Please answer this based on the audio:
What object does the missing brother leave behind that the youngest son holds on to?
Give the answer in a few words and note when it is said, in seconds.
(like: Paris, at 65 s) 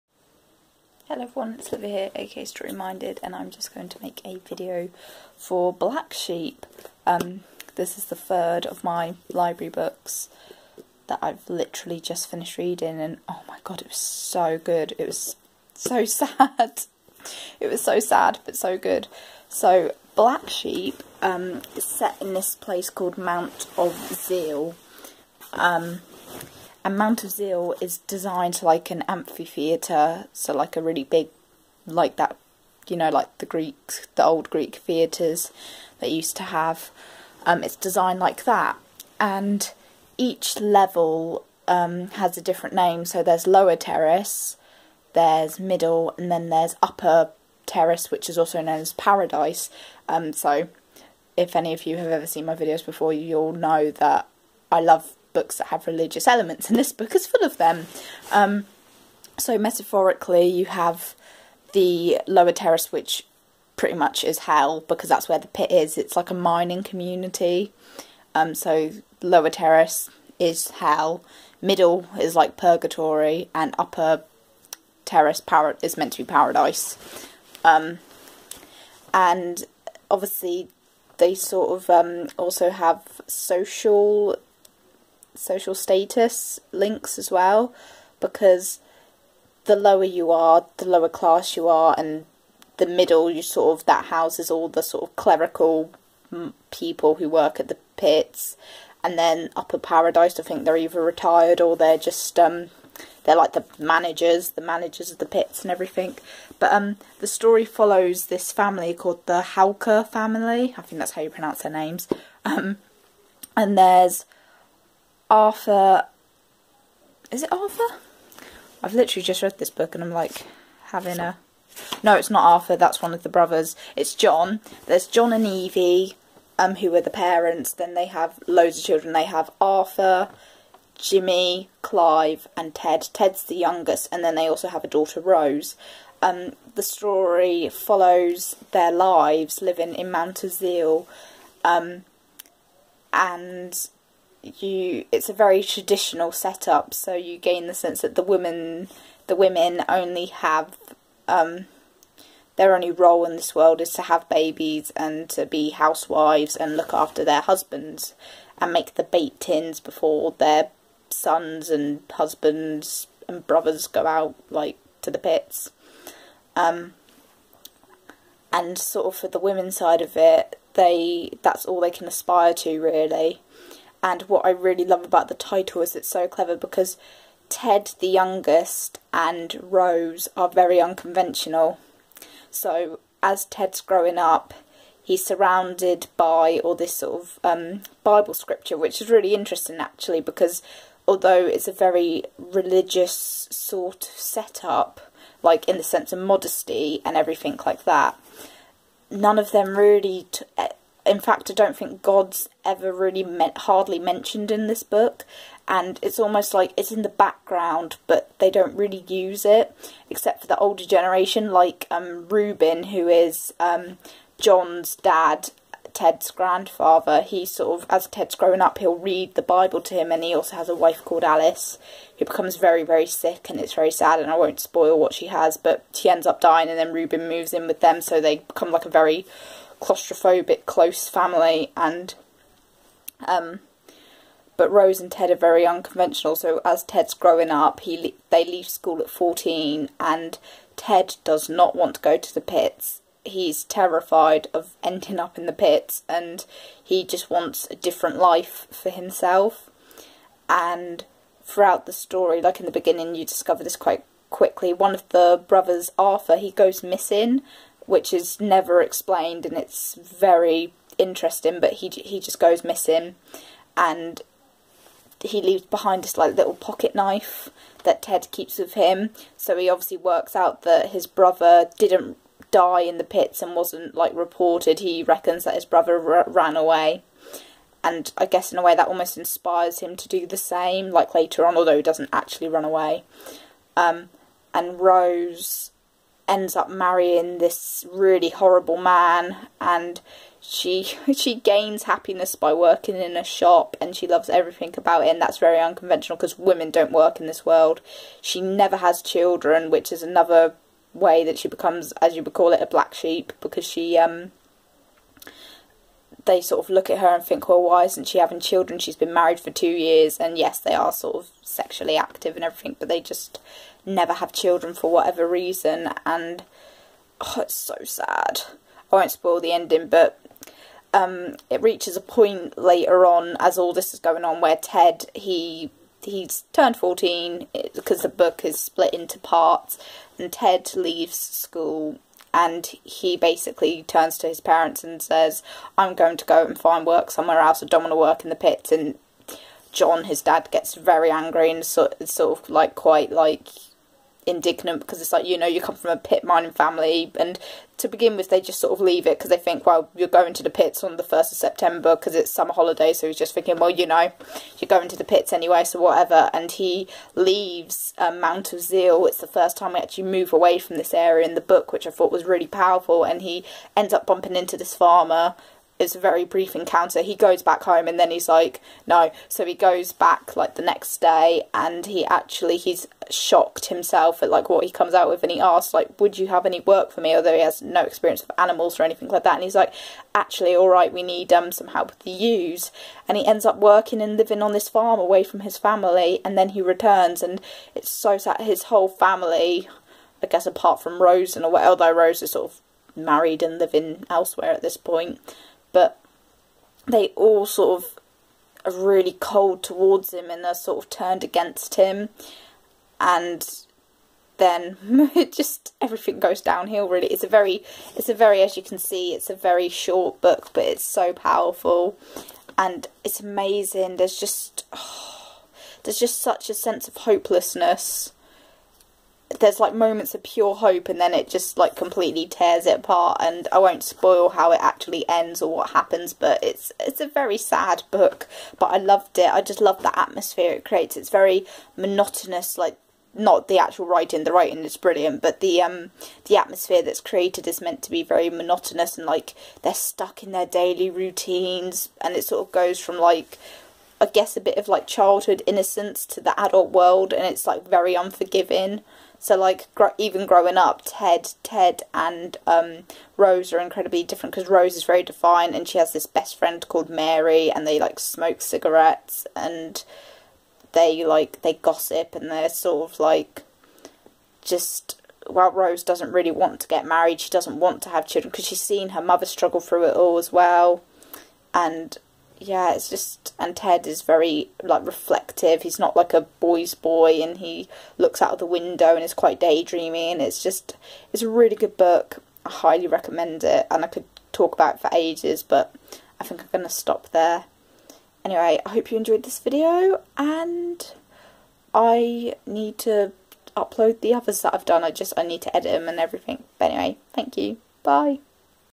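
pocket knife, at 266 s.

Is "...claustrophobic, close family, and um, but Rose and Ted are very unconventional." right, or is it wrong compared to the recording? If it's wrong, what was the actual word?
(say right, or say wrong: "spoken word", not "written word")
right.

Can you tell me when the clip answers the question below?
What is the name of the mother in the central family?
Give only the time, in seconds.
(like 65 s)
125 s.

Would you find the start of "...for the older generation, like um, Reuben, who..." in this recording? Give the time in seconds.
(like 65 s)
210 s.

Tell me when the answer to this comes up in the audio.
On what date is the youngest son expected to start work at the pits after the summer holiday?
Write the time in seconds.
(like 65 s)
351 s.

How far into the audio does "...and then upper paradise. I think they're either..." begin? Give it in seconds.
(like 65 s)
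99 s.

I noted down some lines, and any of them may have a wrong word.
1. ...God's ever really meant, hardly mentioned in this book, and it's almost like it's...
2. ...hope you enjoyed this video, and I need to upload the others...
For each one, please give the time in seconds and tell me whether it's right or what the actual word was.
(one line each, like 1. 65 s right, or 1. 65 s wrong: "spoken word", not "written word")
1. 202 s right
2. 488 s right.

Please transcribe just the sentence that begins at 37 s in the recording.
Um, it's designed like that, and each level um, has a different name.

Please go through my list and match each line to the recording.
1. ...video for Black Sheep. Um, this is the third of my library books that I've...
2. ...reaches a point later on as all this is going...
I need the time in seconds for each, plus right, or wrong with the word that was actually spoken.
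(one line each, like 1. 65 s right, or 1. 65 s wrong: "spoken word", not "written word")
1. 4 s right
2. 321 s right.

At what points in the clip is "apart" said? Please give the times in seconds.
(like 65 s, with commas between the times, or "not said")
390 s, 422 s.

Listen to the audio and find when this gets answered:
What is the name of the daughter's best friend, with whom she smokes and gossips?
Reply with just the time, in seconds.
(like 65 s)
456 s.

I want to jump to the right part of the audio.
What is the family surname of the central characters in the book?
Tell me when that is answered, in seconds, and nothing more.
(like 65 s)
109 s.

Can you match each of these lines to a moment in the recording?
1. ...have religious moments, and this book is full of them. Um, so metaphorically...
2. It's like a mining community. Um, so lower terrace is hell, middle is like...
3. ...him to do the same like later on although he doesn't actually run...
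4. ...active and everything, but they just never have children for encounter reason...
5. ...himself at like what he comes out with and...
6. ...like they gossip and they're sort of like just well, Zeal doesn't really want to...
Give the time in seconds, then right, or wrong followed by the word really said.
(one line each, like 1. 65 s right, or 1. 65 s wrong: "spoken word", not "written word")
1. 55 s wrong: "elements", not "moments"
2. 65 s right
3. 279 s right
4. 311 s wrong: "whatever", not "encounter"
5. 373 s right
6. 461 s wrong: "Rose", not "Zeal".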